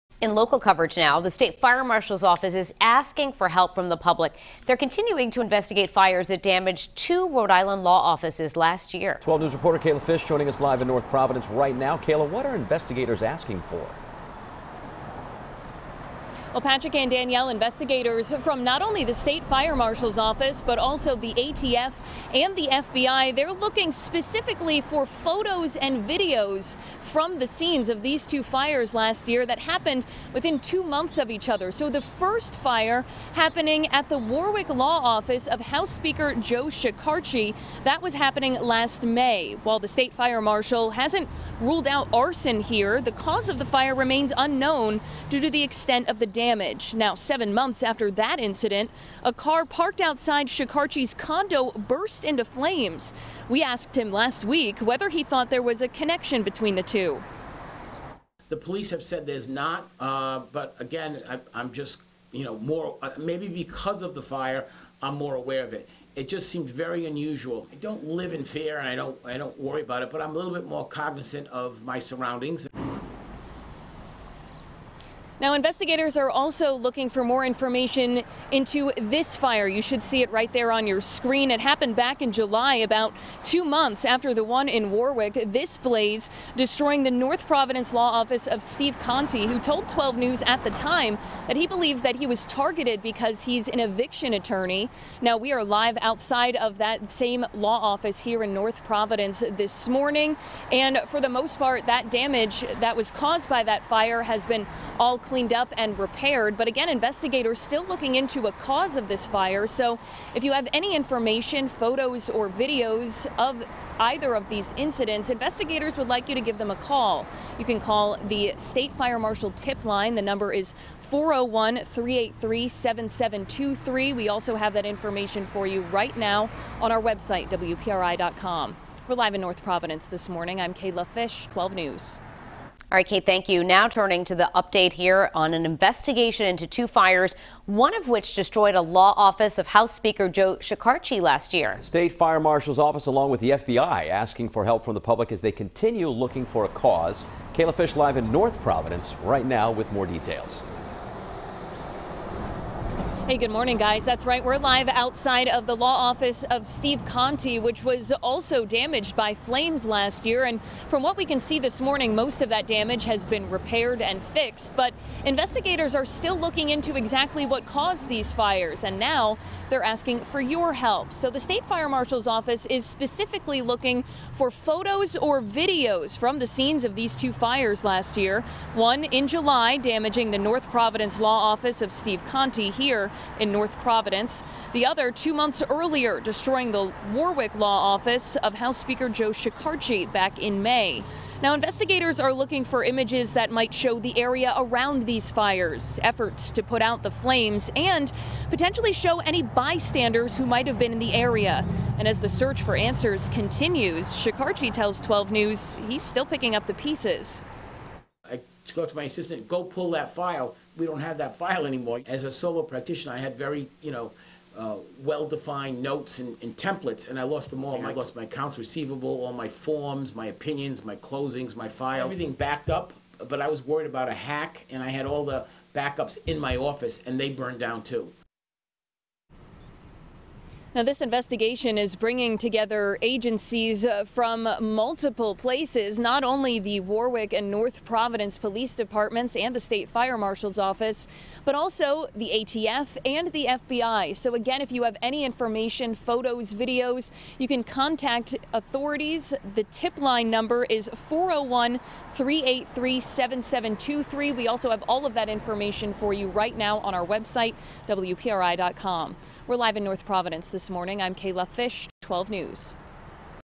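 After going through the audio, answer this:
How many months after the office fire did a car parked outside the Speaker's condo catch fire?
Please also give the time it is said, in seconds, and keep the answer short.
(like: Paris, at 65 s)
7, at 47 s.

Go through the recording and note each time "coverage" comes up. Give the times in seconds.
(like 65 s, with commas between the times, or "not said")
0 s.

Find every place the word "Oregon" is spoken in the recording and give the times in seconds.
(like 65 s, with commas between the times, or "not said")
not said.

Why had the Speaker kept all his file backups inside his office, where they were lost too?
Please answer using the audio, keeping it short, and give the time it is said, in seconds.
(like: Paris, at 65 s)
Worried about a hack, at 223 s.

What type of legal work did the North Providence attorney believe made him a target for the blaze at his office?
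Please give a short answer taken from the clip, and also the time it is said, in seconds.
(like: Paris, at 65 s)
eviction attorney, at 93 s.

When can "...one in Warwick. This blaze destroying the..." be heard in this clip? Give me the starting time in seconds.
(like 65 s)
84 s.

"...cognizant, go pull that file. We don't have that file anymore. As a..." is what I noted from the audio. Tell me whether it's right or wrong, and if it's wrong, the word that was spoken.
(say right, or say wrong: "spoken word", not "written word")
wrong: "assistant", not "cognizant".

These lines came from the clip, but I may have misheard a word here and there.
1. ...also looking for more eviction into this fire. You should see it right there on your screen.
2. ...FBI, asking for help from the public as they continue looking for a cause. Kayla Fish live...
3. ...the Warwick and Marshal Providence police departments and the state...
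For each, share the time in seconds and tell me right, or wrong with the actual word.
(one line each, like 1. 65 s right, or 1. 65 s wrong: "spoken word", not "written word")
1. 76 s wrong: "information", not "eviction"
2. 143 s right
3. 236 s wrong: "North", not "Marshal".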